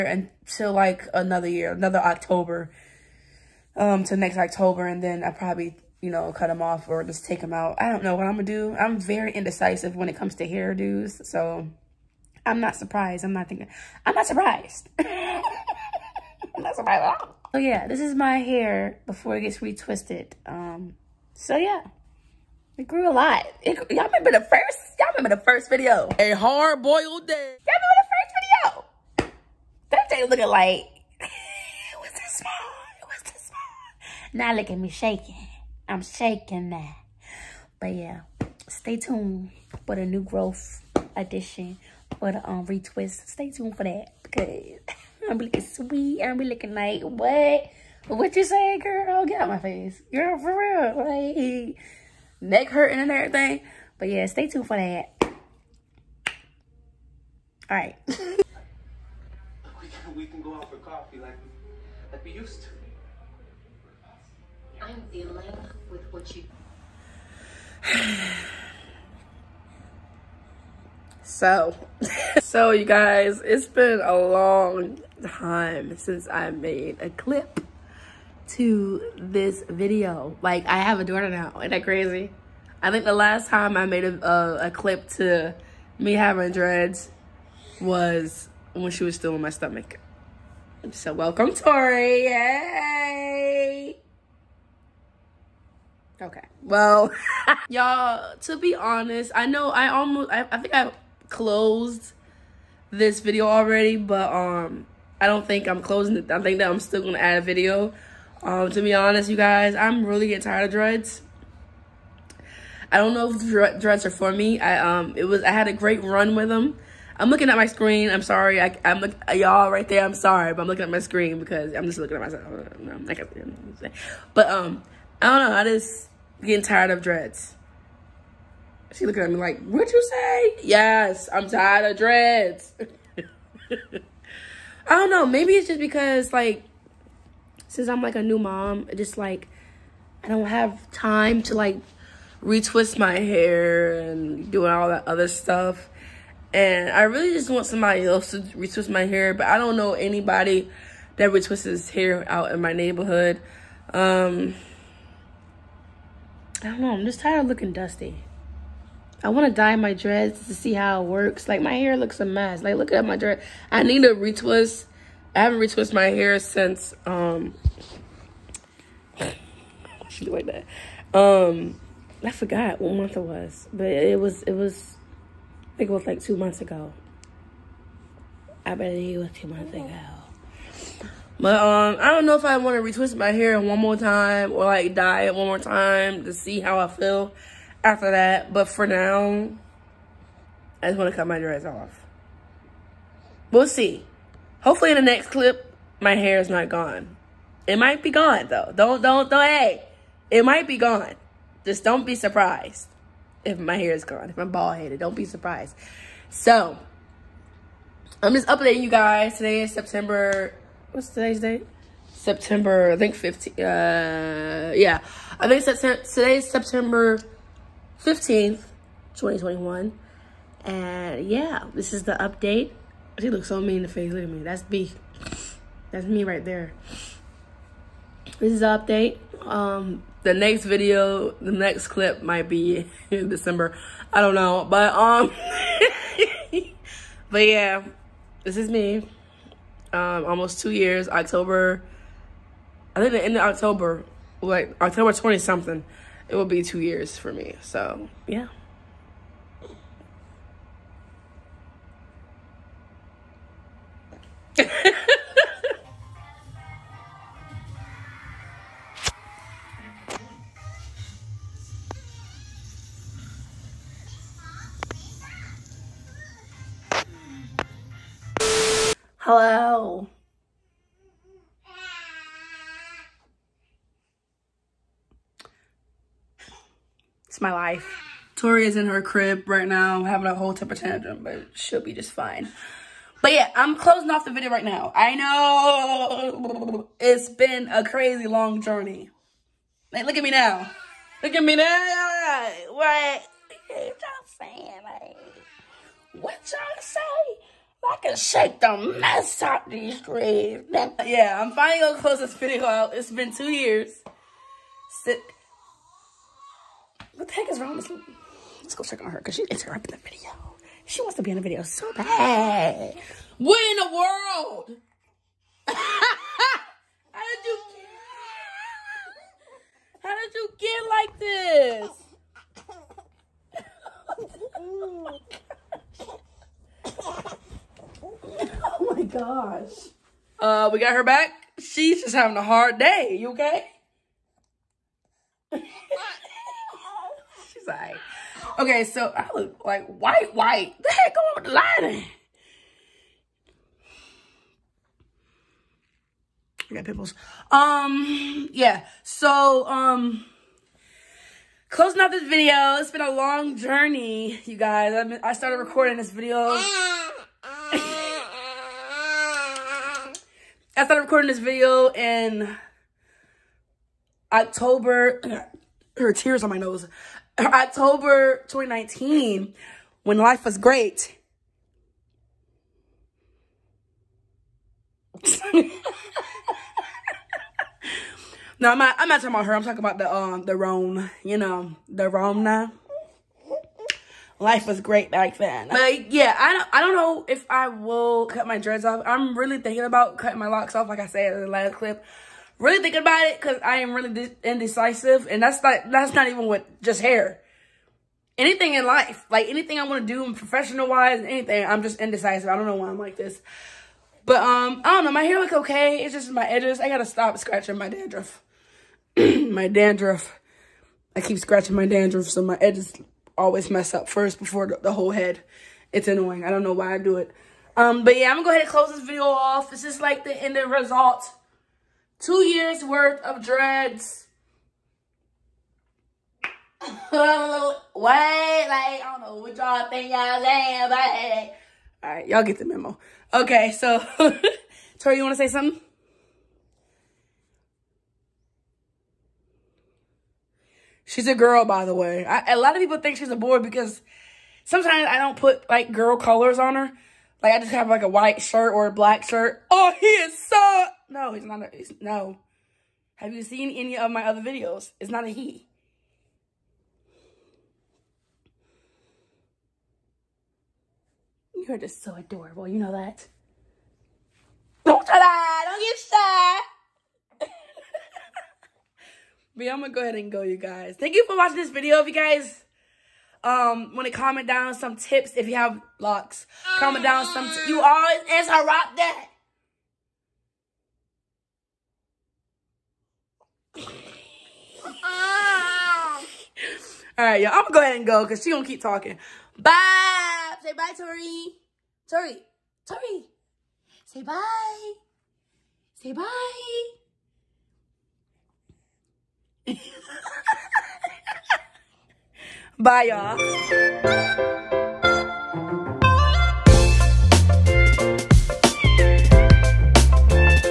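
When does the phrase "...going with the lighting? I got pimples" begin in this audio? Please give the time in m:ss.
5:41.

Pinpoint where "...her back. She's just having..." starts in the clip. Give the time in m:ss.
5:30.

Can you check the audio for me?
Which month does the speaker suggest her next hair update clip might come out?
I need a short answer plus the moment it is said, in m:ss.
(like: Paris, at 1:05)
December, at 3:53.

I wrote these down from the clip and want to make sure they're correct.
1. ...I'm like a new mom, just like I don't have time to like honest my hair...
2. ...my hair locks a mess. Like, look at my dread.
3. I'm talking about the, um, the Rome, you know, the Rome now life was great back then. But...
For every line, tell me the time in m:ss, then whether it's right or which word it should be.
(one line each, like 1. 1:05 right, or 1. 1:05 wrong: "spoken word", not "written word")
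1. 2:17 wrong: "retwist", not "honest"
2. 2:41 wrong: "looks", not "locks"
3. 6:19 right.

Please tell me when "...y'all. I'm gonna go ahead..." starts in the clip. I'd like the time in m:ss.
8:07.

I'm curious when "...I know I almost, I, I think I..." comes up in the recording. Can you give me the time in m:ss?
1:39.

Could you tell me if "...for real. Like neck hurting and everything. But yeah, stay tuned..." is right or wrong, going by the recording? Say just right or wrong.
right.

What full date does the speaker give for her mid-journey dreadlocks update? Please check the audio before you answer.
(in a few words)
September 15th, 2021.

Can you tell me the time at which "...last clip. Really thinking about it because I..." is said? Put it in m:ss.
6:31.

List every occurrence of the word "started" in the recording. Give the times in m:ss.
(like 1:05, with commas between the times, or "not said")
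5:55, 6:00.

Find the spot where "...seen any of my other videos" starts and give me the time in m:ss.
7:33.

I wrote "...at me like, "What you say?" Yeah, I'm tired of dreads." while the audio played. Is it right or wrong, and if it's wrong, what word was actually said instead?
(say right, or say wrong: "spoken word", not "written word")
wrong: "Yes", not "Yeah".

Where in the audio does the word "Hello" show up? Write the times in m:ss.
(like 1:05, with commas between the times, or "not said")
4:29.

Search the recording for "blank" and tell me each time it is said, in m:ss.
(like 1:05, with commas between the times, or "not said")
not said.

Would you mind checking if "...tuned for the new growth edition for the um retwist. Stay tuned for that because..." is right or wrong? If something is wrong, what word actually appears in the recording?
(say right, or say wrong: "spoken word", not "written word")
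right.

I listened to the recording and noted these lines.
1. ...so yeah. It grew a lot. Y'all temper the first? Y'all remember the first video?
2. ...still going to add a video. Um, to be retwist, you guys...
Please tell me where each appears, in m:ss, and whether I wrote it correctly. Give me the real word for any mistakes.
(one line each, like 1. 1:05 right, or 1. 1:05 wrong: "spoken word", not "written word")
1. 0:21 wrong: "remember", not "temper"
2. 1:46 wrong: "honest", not "retwist".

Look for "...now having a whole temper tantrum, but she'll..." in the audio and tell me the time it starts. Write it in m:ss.
4:39.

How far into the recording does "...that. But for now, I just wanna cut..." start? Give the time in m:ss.
3:08.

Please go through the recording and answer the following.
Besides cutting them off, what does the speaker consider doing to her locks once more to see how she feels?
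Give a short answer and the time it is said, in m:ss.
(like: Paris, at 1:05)
dye it, at 3:04.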